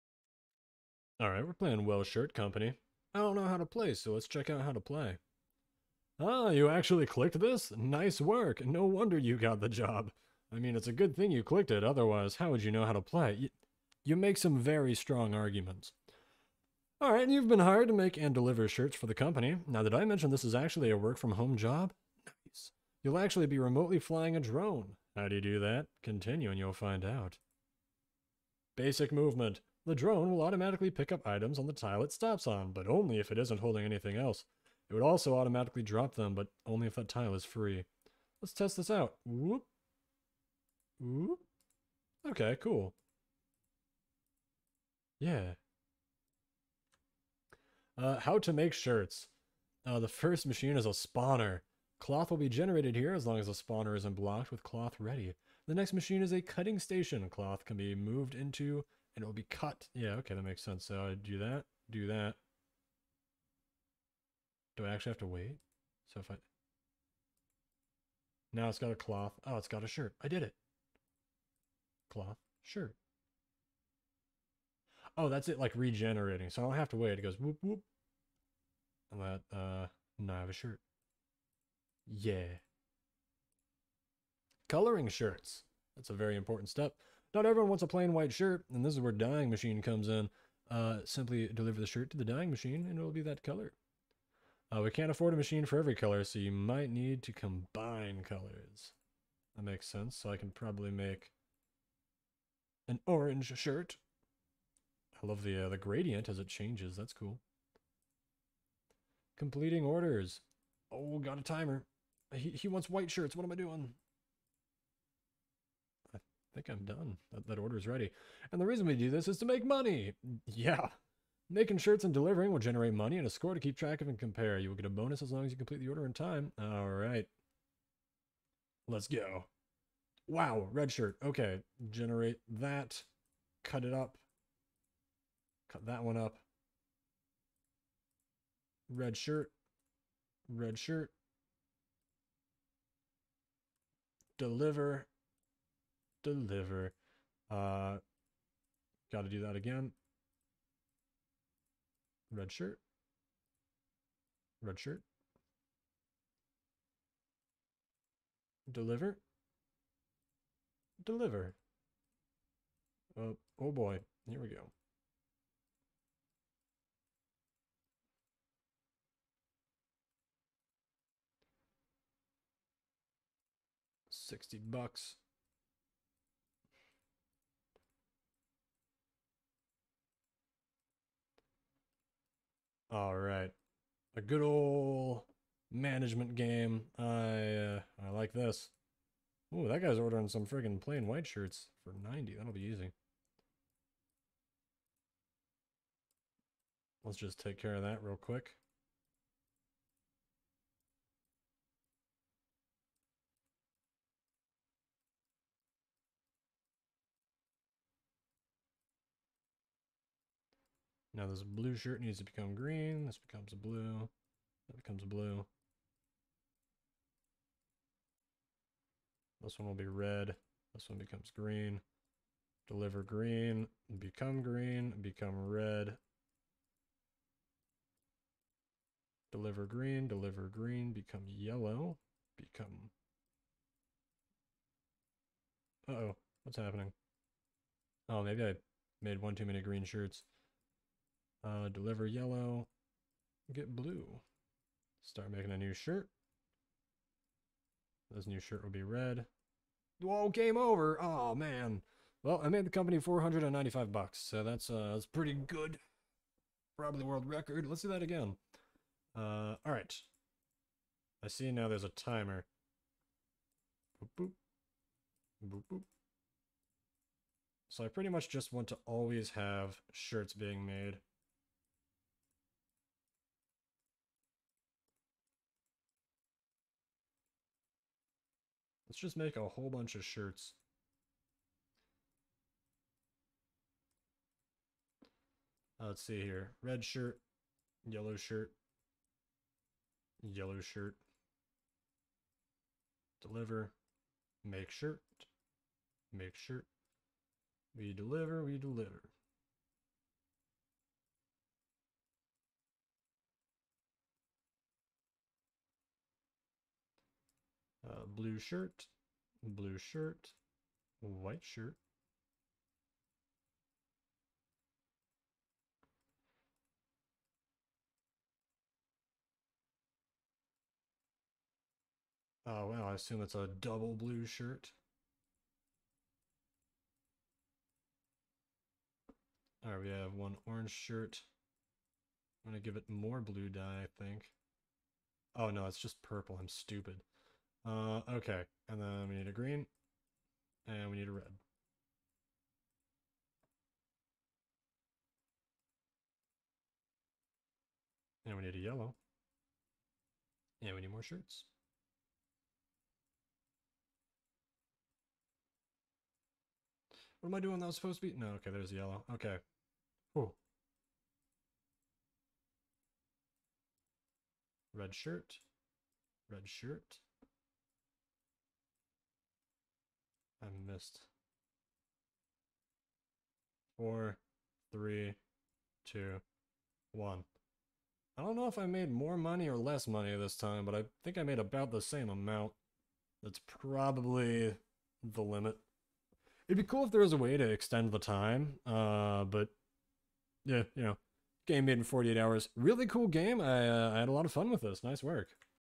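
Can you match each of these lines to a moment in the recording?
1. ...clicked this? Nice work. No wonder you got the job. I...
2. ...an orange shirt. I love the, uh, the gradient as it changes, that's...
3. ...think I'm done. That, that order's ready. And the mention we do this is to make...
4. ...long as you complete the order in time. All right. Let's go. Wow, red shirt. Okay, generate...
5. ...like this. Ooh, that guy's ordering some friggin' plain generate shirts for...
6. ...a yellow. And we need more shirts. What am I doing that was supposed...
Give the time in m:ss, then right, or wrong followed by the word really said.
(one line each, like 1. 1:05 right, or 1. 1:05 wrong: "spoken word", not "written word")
1. 0:07 right
2. 1:42 right
3. 1:56 wrong: "reason", not "mention"
4. 2:05 right
5. 3:08 wrong: "white", not "generate"
6. 5:48 right.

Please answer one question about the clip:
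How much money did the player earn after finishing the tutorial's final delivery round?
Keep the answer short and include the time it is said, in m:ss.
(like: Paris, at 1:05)
$60, at 2:54.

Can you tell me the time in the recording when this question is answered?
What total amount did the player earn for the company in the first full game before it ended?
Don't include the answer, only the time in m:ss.
4:12.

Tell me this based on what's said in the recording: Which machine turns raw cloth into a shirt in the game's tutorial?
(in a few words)
cutting station.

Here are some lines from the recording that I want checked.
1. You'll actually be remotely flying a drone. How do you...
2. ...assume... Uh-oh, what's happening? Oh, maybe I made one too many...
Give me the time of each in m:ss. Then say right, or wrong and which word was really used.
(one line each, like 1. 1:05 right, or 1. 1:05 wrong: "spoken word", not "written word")
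1. 0:23 right
2. 3:52 wrong: "become", not "assume".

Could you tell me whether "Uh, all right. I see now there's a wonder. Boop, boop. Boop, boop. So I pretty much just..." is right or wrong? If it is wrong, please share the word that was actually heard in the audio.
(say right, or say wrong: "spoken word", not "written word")
wrong: "timer", not "wonder".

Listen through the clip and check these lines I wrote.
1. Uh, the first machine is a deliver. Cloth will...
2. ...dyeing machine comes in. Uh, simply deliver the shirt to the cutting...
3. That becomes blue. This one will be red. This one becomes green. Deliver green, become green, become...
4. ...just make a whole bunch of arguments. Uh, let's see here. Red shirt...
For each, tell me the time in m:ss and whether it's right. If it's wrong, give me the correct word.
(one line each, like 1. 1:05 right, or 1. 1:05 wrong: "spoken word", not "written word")
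1. 0:49 wrong: "spawner", not "deliver"
2. 1:29 wrong: "dyeing", not "cutting"
3. 3:34 right
4. 4:38 wrong: "shirts", not "arguments".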